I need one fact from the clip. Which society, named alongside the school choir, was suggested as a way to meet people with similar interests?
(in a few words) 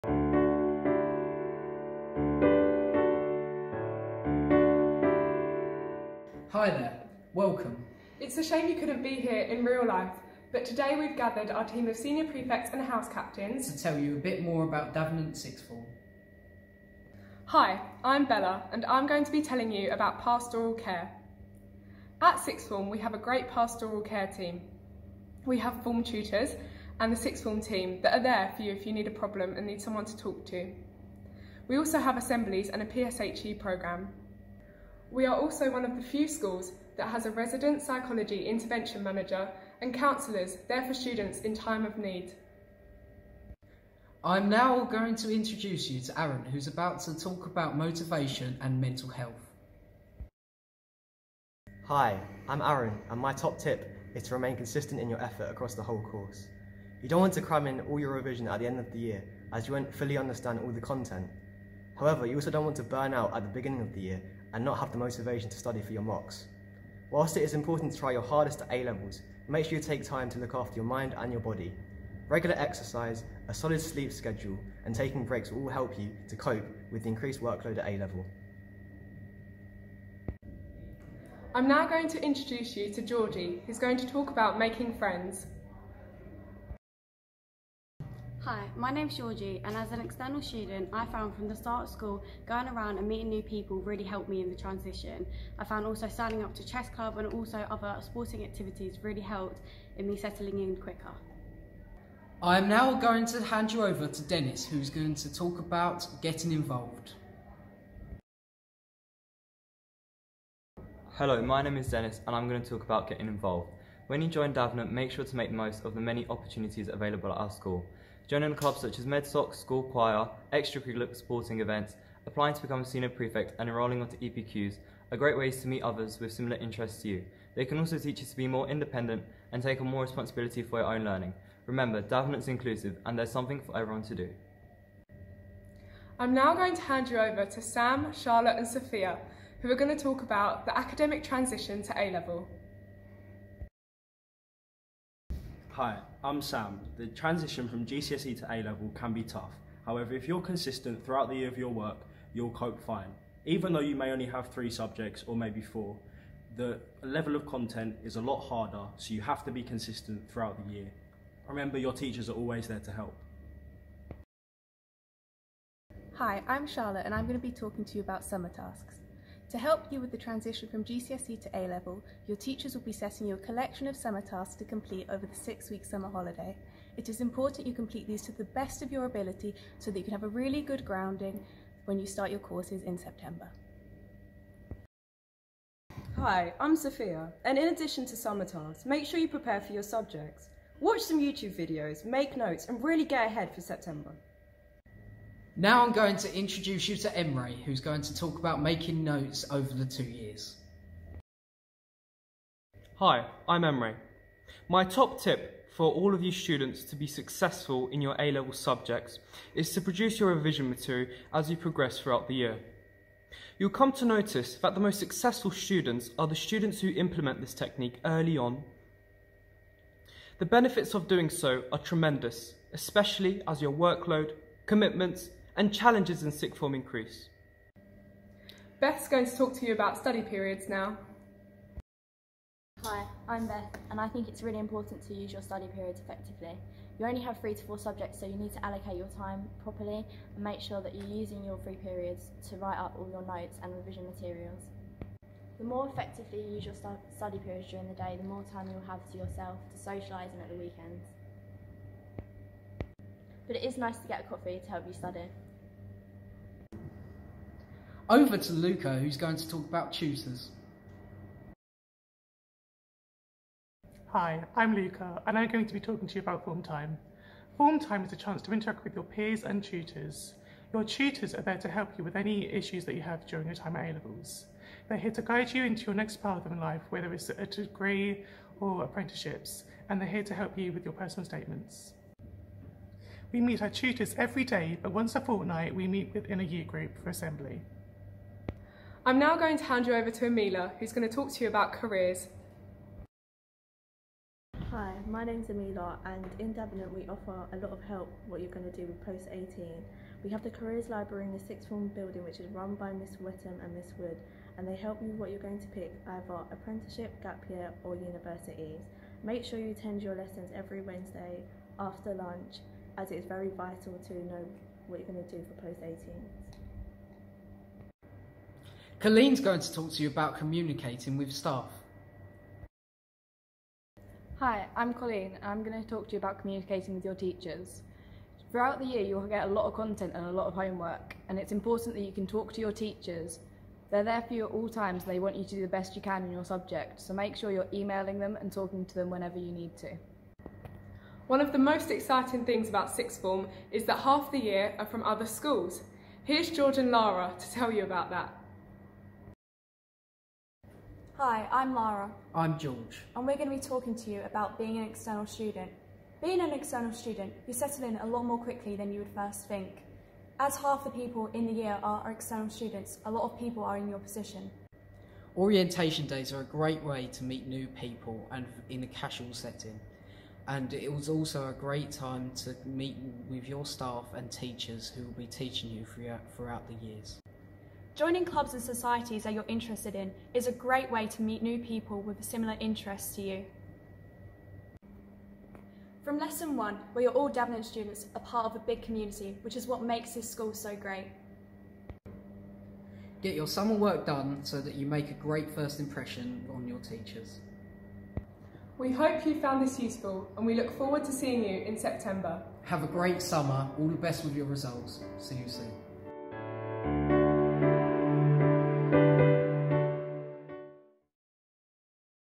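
MedSoc.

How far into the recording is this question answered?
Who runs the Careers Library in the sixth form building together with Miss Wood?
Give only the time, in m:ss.
5:02.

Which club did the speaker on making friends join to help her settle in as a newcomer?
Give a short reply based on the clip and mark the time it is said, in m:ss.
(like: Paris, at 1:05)
Chess club, at 1:36.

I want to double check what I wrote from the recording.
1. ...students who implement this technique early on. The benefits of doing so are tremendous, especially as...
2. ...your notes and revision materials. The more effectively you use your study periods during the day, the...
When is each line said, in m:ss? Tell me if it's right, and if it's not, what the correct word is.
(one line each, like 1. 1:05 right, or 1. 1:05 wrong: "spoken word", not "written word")
1. 3:36 right
2. 4:03 right.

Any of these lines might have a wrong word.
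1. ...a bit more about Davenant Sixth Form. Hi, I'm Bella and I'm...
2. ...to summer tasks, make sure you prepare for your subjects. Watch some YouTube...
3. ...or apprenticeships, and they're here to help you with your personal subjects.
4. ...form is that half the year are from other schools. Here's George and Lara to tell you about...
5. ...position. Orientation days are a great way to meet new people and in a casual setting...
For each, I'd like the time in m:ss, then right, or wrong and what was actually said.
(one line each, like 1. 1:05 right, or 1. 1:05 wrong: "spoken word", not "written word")
1. 0:14 right
2. 3:08 right
3. 4:38 wrong: "statements", not "subjects"
4. 5:43 right
5. 6:03 right.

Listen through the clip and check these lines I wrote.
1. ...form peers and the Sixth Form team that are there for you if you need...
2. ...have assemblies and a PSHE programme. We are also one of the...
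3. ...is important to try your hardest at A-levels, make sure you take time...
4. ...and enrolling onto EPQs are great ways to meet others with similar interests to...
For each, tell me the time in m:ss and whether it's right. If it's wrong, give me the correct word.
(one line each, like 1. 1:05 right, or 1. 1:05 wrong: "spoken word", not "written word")
1. 0:25 wrong: "tutors", not "peers"
2. 0:31 right
3. 1:07 right
4. 2:03 right.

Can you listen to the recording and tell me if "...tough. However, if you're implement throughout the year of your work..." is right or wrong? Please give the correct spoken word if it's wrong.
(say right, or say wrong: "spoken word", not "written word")
wrong: "consistent", not "implement".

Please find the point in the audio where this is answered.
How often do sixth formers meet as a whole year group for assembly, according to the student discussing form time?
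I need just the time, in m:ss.
4:44.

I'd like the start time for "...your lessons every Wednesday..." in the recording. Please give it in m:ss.
5:10.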